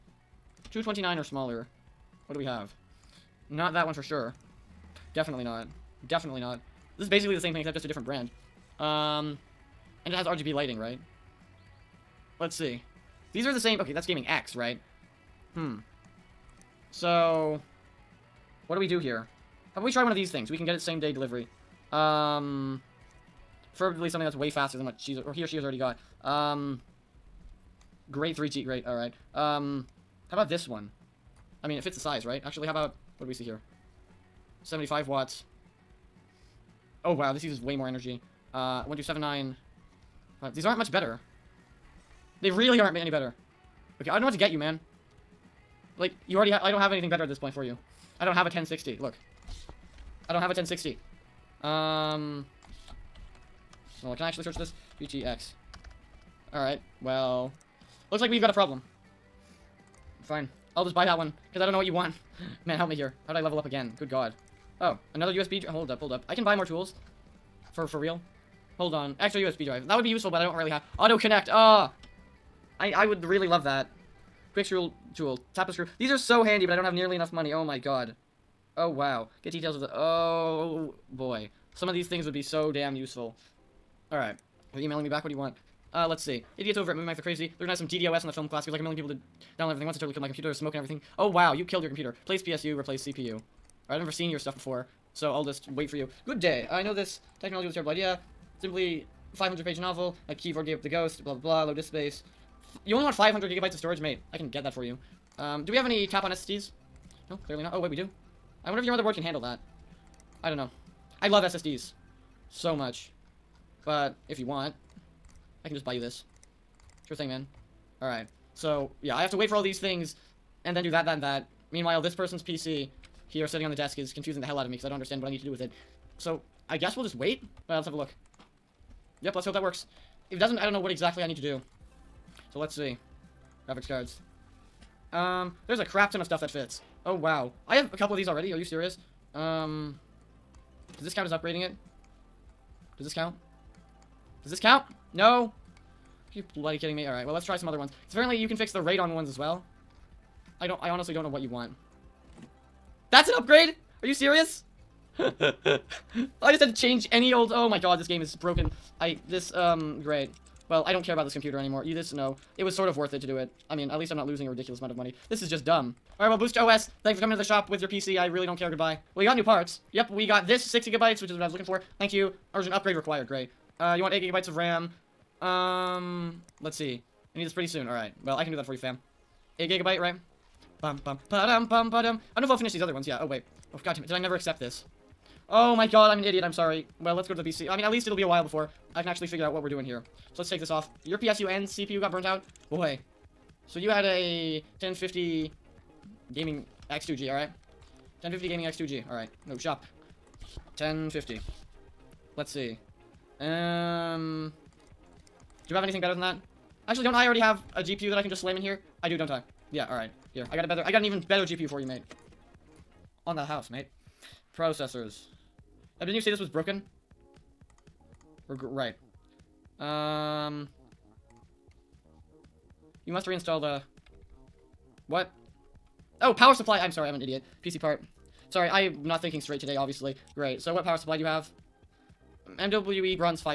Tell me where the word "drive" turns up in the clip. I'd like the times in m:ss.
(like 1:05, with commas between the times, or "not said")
1:09.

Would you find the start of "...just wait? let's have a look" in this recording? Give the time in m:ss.
2:07.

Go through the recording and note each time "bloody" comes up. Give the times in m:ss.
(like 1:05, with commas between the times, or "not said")
2:26.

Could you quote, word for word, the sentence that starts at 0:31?
I mean, it fits the size, right?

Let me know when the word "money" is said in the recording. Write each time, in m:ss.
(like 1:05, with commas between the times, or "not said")
1:17, 2:44.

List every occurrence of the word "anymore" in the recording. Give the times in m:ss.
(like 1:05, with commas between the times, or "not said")
2:41.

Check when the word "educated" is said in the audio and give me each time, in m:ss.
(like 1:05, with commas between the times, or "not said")
not said.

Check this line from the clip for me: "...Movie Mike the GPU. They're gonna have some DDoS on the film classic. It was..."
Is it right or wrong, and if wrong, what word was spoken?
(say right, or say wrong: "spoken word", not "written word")
wrong: "Crazy", not "GPU".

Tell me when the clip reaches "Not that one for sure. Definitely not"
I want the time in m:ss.
0:03.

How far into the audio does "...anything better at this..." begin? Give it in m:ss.
0:46.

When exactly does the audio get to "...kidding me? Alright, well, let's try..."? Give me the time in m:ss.
2:26.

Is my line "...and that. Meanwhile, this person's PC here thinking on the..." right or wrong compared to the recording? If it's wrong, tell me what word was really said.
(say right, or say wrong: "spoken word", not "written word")
wrong: "sitting", not "thinking".